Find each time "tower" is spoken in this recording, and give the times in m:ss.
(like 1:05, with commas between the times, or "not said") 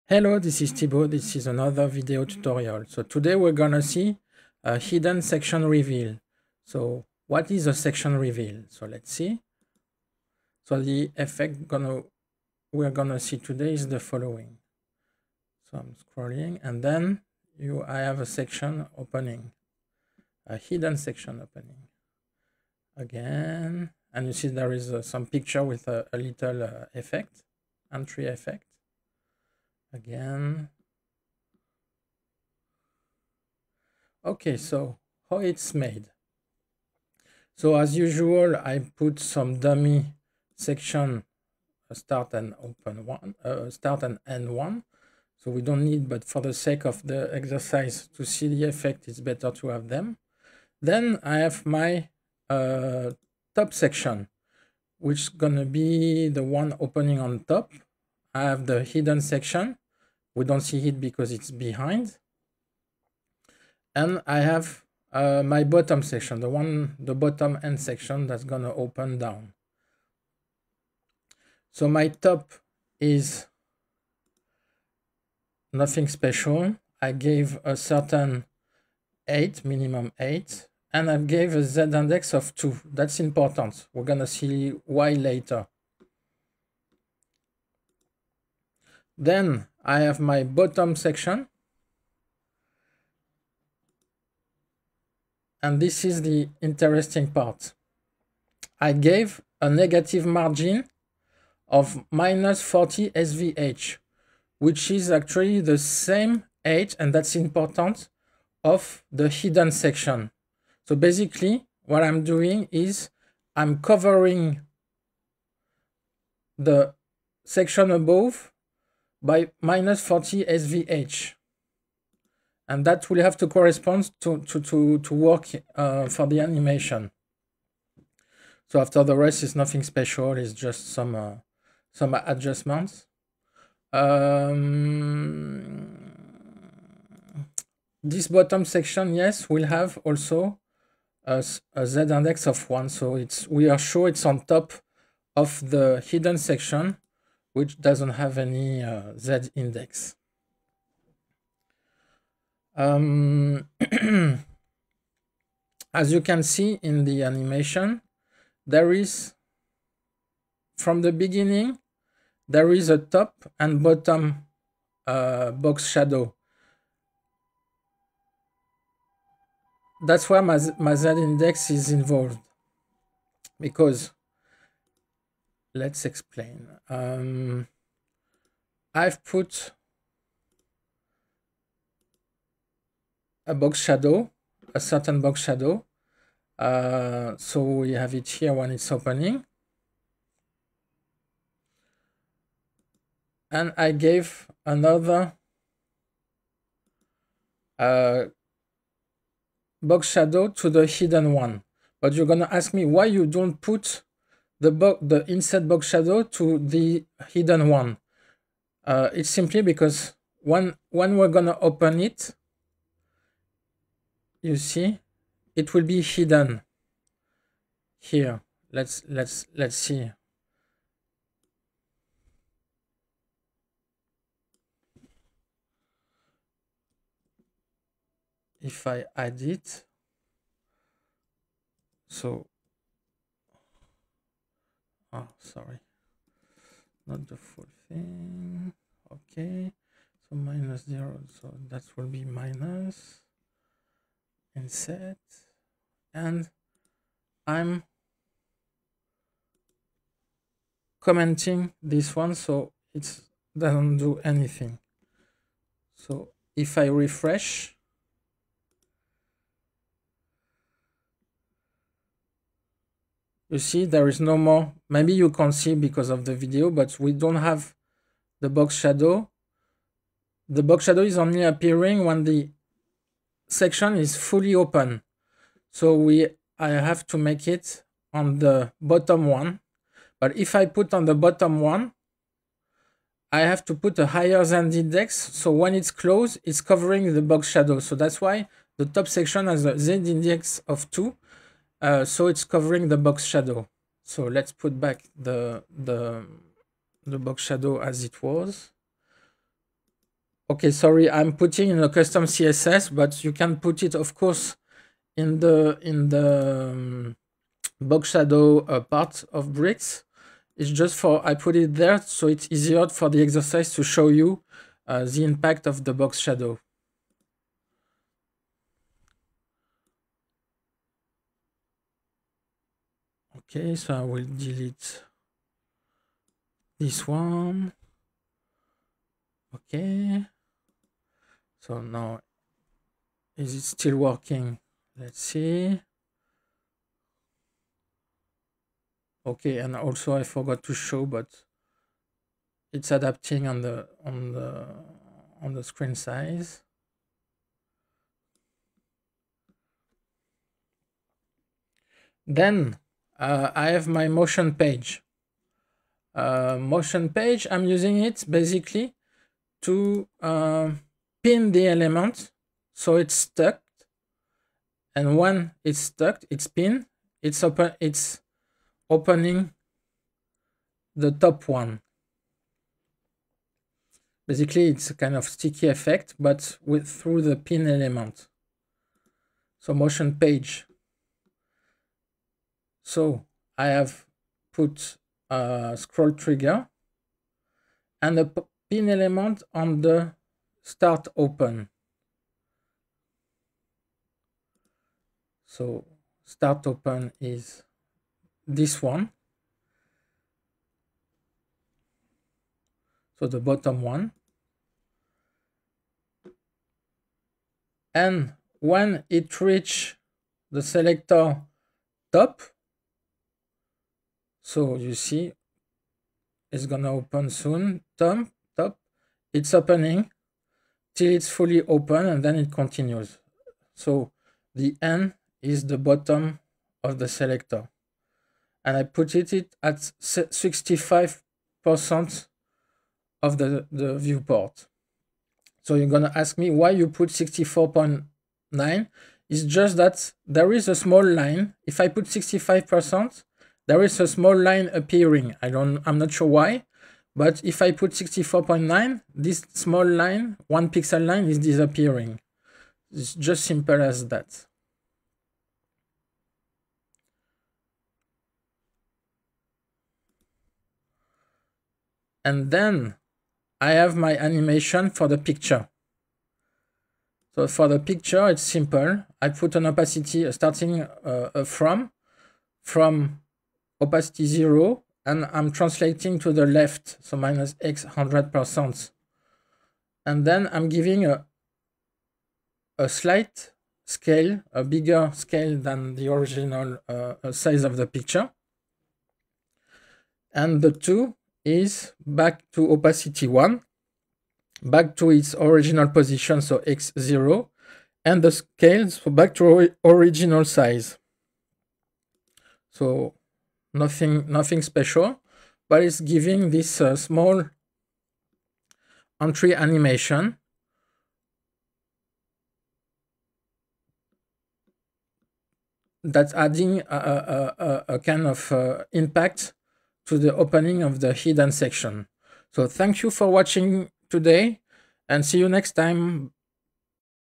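not said.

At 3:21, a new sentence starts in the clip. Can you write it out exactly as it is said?
But you're going to ask me why you don't put the, the inset box shadow to the hidden one.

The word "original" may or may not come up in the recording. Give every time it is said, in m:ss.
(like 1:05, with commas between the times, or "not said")
8:06, 8:15, 8:19.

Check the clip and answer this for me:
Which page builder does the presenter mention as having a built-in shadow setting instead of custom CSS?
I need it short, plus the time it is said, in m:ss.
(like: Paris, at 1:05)
Bricks, at 5:09.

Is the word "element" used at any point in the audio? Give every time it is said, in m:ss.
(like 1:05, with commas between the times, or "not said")
6:01, 6:17, 6:28.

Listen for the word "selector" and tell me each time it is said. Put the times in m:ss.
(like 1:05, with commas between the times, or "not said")
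6:50, 7:07.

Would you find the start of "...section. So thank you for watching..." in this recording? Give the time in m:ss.
8:41.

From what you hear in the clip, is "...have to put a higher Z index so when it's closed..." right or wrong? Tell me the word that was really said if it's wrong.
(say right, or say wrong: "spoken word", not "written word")
right.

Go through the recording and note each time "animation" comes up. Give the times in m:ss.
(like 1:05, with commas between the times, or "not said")
2:06, 2:37, 7:44, 8:29.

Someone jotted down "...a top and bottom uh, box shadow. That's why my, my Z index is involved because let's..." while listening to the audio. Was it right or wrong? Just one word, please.
right.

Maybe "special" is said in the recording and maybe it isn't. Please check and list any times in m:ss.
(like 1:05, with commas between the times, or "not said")
1:16, 2:09, 8:24.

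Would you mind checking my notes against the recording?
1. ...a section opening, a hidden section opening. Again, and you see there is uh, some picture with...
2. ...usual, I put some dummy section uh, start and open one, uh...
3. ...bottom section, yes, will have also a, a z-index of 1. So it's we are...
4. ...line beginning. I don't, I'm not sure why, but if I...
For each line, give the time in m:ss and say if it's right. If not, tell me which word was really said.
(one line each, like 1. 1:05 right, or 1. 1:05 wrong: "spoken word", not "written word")
1. 0:18 right
2. 0:37 right
3. 2:18 right
4. 7:24 wrong: "appearing", not "beginning".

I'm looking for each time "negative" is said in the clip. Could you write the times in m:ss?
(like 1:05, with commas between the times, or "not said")
1:39.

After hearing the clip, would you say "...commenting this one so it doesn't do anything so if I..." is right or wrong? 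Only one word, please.
right.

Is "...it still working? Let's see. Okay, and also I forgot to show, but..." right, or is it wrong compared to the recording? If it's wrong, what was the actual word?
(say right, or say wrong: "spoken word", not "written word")
right.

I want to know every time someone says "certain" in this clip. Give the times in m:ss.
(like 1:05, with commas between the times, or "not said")
1:17, 3:04.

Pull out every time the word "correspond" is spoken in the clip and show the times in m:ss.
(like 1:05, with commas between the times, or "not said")
2:03.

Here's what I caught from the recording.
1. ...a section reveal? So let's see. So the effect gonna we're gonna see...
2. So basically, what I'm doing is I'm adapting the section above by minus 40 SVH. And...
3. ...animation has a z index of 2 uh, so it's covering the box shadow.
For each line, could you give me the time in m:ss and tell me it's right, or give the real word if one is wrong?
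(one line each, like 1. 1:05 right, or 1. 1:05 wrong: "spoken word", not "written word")
1. 0:07 right
2. 1:50 wrong: "covering", not "adapting"
3. 4:49 wrong: "section", not "animation".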